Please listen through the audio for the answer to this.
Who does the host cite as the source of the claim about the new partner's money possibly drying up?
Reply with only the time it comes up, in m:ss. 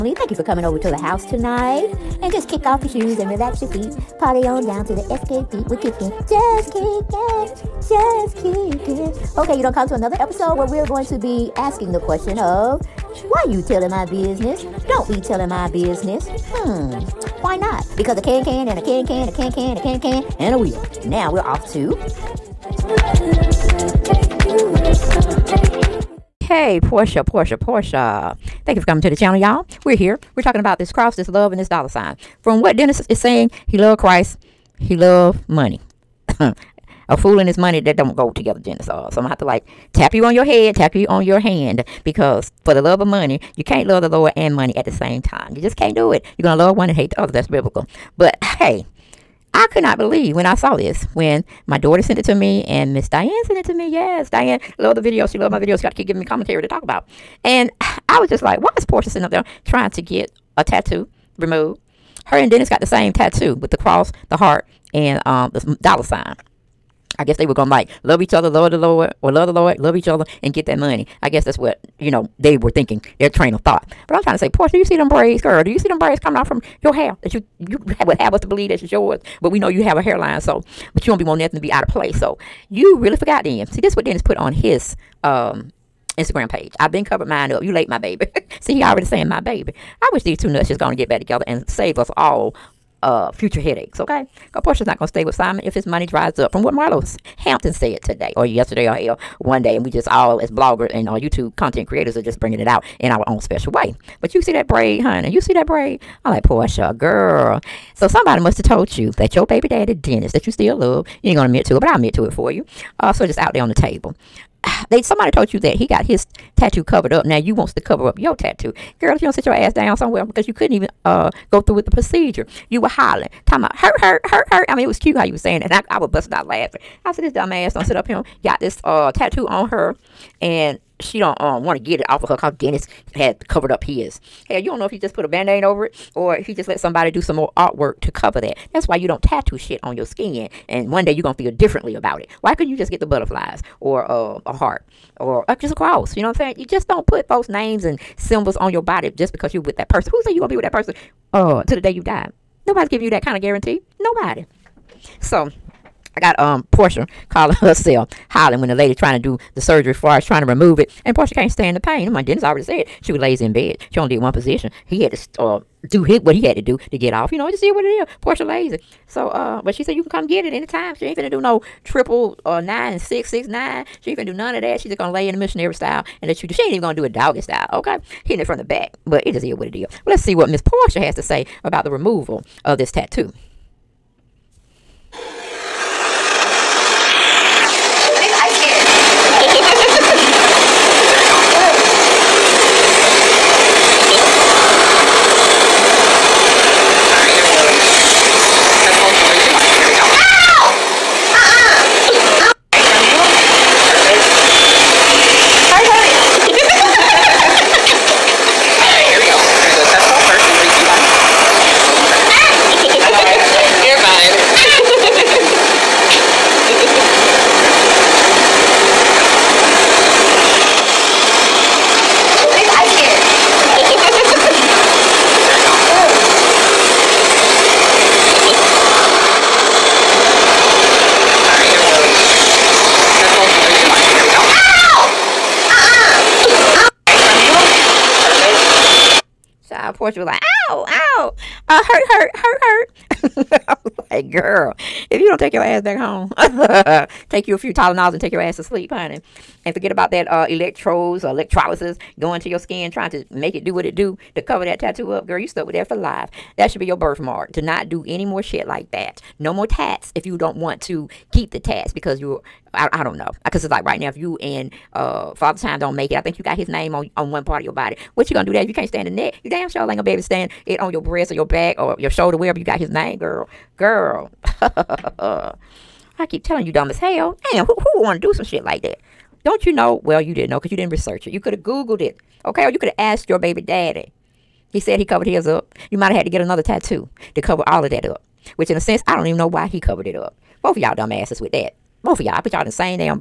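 1:36.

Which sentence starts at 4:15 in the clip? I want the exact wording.
Girl, you stuck with that for life.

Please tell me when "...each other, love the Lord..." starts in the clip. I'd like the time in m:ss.
1:08.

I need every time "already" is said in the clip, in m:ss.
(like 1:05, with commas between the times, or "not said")
1:28, 2:42.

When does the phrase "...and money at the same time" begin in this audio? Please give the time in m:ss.
0:44.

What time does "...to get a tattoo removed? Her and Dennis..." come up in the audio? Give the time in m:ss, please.
0:59.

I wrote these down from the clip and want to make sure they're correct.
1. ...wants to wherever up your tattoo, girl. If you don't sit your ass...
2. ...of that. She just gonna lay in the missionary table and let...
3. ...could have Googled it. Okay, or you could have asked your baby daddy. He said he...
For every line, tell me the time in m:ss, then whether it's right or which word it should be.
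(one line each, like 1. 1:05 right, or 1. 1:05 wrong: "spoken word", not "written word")
1. 1:57 wrong: "cover", not "wherever"
2. 2:54 wrong: "style", not "table"
3. 4:41 right.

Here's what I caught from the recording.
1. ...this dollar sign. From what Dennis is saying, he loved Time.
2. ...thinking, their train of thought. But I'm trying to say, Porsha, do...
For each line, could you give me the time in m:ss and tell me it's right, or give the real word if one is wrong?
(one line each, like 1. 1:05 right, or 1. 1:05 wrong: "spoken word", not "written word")
1. 0:31 wrong: "Christ", not "Time"
2. 1:12 right.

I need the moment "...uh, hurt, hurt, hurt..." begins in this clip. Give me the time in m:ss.
4:01.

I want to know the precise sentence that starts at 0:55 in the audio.
She got to keep giving me commentary to talk about.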